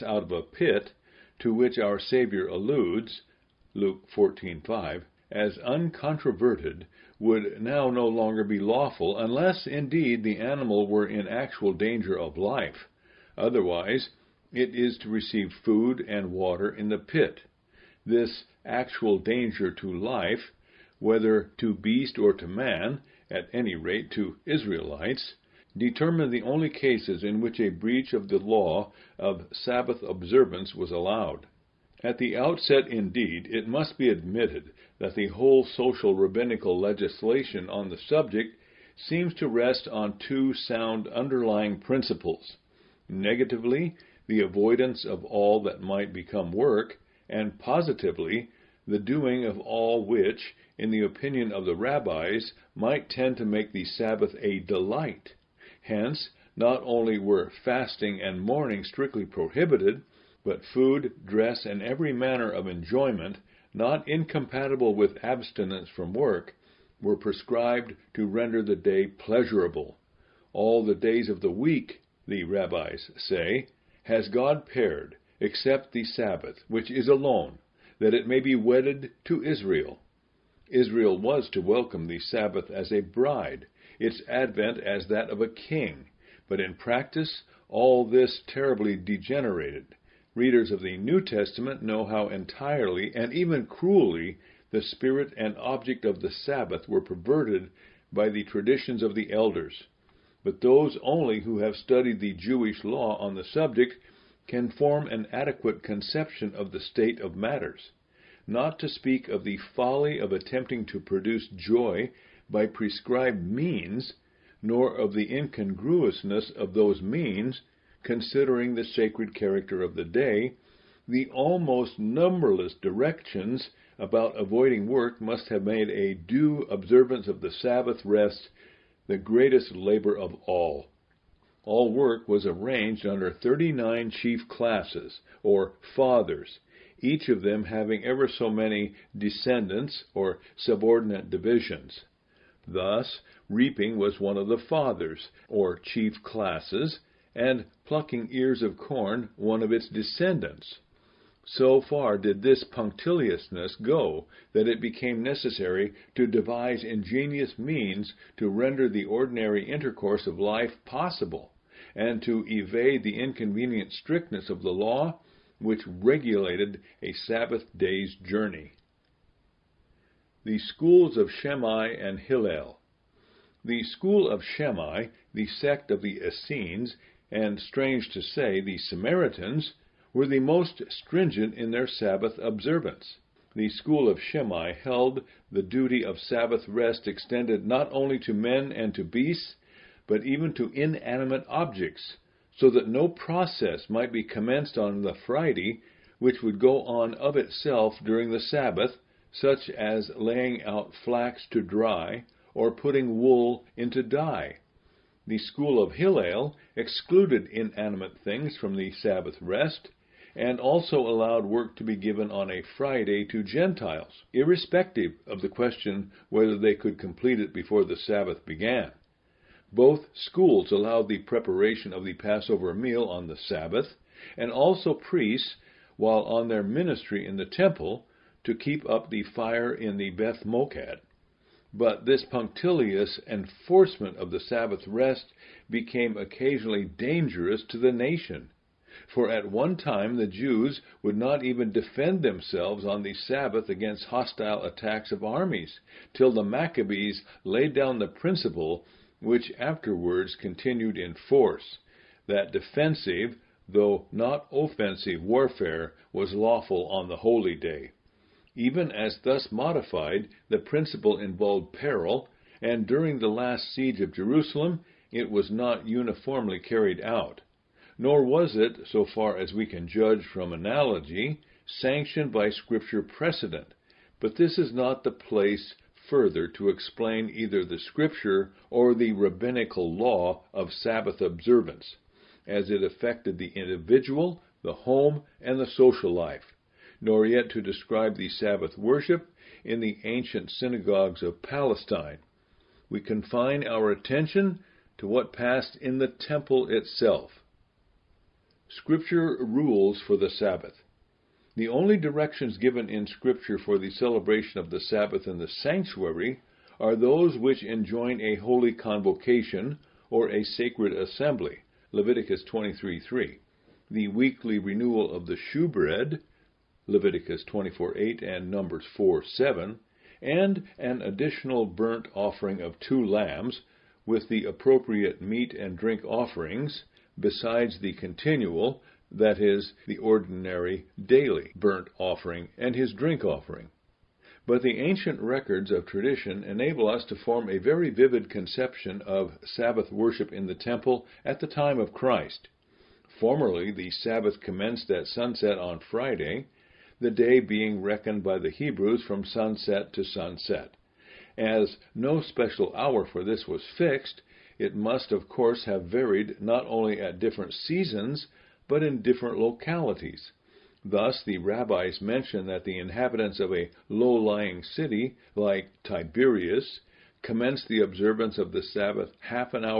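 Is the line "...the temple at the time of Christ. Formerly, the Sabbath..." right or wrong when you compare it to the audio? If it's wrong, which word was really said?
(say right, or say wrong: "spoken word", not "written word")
right.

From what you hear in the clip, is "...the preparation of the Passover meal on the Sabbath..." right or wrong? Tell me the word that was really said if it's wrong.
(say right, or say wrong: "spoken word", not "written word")
right.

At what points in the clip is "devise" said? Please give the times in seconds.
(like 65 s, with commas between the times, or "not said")
156 s.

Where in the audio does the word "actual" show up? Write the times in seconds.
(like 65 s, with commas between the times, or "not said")
11 s, 18 s.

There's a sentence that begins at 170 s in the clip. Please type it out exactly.
The schools of Shammai and Hillel.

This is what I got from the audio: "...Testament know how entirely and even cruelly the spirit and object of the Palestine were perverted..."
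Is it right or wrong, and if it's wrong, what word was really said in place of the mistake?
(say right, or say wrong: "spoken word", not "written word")
wrong: "Sabbath", not "Palestine".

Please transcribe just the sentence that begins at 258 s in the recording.
Even as thus modified, the principle involved peril, and during the last siege of Jerusalem it was not uniformly carried out.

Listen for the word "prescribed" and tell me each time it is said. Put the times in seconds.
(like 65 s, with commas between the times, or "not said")
67 s, 112 s.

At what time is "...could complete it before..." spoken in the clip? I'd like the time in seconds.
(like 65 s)
216 s.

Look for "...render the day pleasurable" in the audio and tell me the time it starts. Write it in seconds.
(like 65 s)
68 s.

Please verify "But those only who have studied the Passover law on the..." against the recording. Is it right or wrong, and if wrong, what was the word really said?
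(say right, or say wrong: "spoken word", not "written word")
wrong: "Jewish", not "Passover".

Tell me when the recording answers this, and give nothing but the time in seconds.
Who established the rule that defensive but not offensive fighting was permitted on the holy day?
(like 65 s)
246 s.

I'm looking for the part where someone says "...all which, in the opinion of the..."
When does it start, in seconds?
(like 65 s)
49 s.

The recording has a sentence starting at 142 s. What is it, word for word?
Thus, reaping was one of the fathers, or chief classes, and plucking ears of corn one of its descendants.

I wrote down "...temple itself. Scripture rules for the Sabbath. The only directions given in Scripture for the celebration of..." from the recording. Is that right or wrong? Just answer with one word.
right.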